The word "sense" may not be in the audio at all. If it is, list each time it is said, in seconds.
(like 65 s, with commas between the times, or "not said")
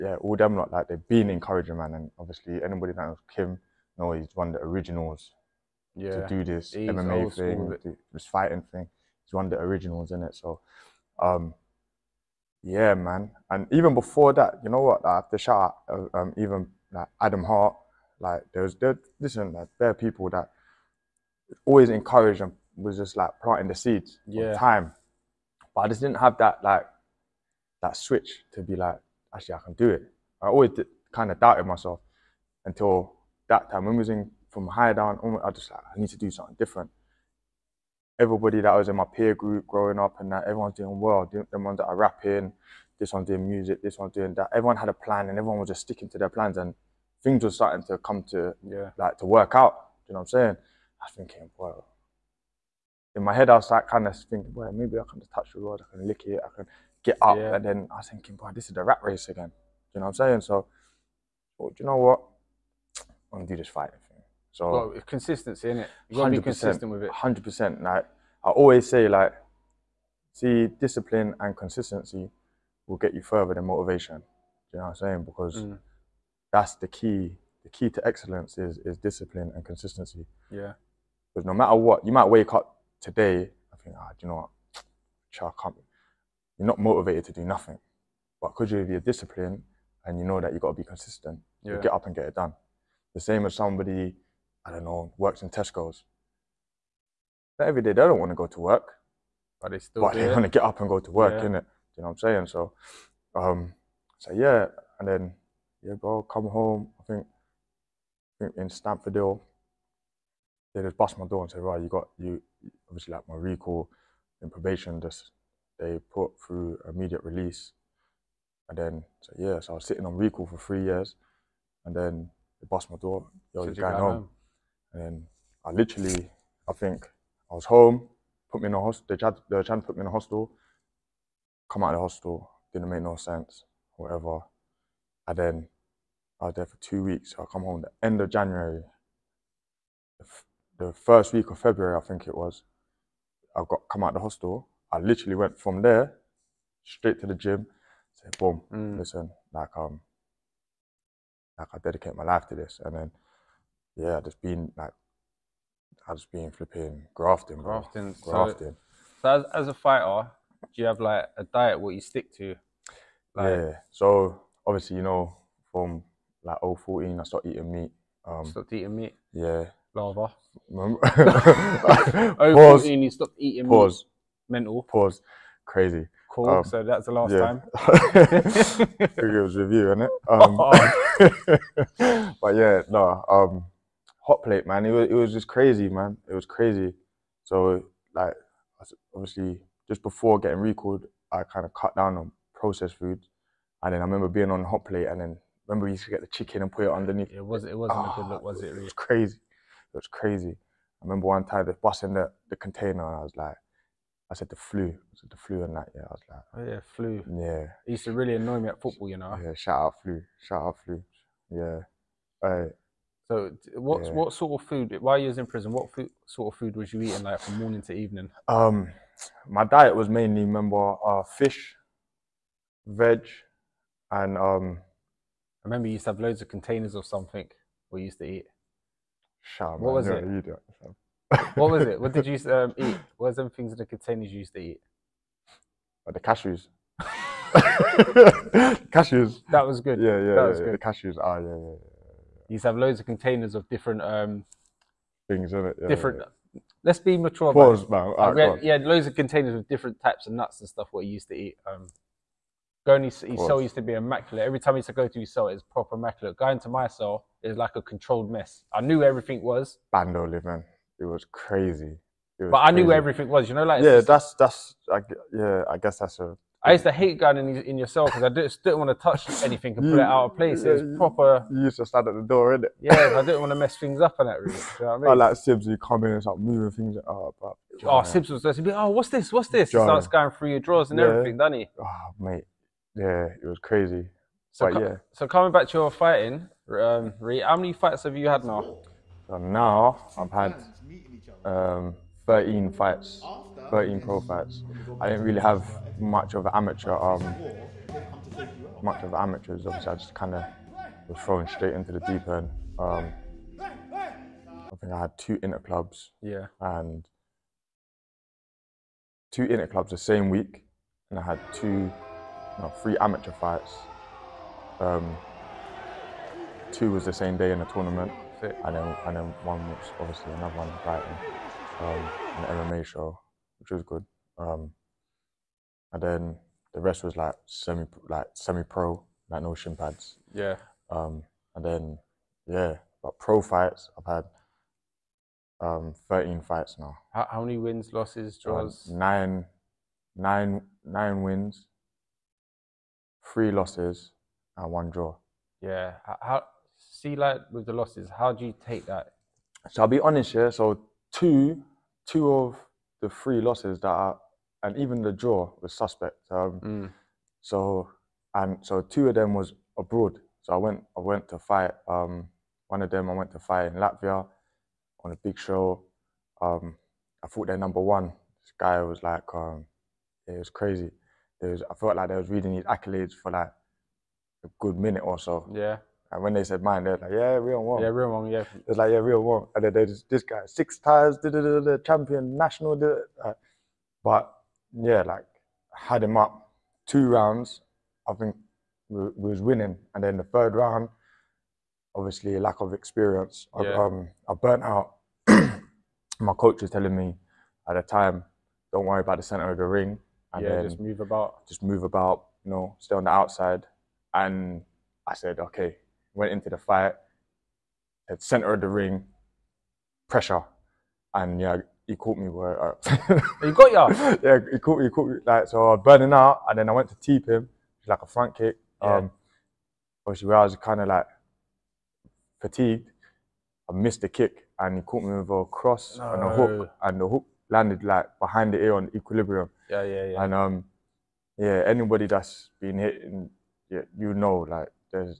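133 s.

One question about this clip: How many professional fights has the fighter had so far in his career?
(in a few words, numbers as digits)
13.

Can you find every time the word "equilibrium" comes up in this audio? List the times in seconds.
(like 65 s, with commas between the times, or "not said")
428 s.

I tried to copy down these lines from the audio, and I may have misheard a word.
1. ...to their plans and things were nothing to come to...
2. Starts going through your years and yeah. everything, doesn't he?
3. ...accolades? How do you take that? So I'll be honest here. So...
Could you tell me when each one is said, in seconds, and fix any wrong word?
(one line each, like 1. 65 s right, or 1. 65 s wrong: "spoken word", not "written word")
1. 46 s wrong: "starting", not "nothing"
2. 279 s wrong: "drawers", not "years"
3. 347 s wrong: "losses", not "accolades".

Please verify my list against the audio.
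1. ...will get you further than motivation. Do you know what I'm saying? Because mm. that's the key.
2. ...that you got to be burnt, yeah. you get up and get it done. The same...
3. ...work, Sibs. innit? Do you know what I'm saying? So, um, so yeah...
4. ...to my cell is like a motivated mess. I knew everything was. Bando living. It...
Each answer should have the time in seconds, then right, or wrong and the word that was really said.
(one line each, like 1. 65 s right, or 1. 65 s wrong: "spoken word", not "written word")
1. 72 s right
2. 90 s wrong: "consistent", not "burnt"
3. 101 s wrong: "Yeah", not "Sibs"
4. 256 s wrong: "controlled", not "motivated".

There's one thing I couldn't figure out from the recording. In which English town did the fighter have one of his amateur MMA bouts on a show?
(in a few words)
Brighton.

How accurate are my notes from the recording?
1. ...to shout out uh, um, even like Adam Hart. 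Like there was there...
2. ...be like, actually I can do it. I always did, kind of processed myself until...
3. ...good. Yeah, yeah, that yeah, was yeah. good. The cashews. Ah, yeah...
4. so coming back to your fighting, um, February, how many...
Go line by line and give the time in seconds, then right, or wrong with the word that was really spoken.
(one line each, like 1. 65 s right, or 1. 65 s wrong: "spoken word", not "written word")
1. 15 s right
2. 28 s wrong: "doubted", not "processed"
3. 239 s right
4. 285 s wrong: "Ree", not "February".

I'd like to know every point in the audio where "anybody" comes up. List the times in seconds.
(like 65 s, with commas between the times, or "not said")
2 s, 431 s.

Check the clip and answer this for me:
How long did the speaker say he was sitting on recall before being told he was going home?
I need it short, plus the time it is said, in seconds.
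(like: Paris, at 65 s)
3 years, at 120 s.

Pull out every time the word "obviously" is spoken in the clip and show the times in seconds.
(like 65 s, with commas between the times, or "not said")
2 s, 112 s, 164 s, 189 s, 299 s, 319 s, 391 s, 420 s.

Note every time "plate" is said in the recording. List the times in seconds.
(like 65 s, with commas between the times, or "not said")
184 s, 194 s.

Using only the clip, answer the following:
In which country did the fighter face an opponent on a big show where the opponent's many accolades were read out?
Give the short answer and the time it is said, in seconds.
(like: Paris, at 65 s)
Latvia, at 363 s.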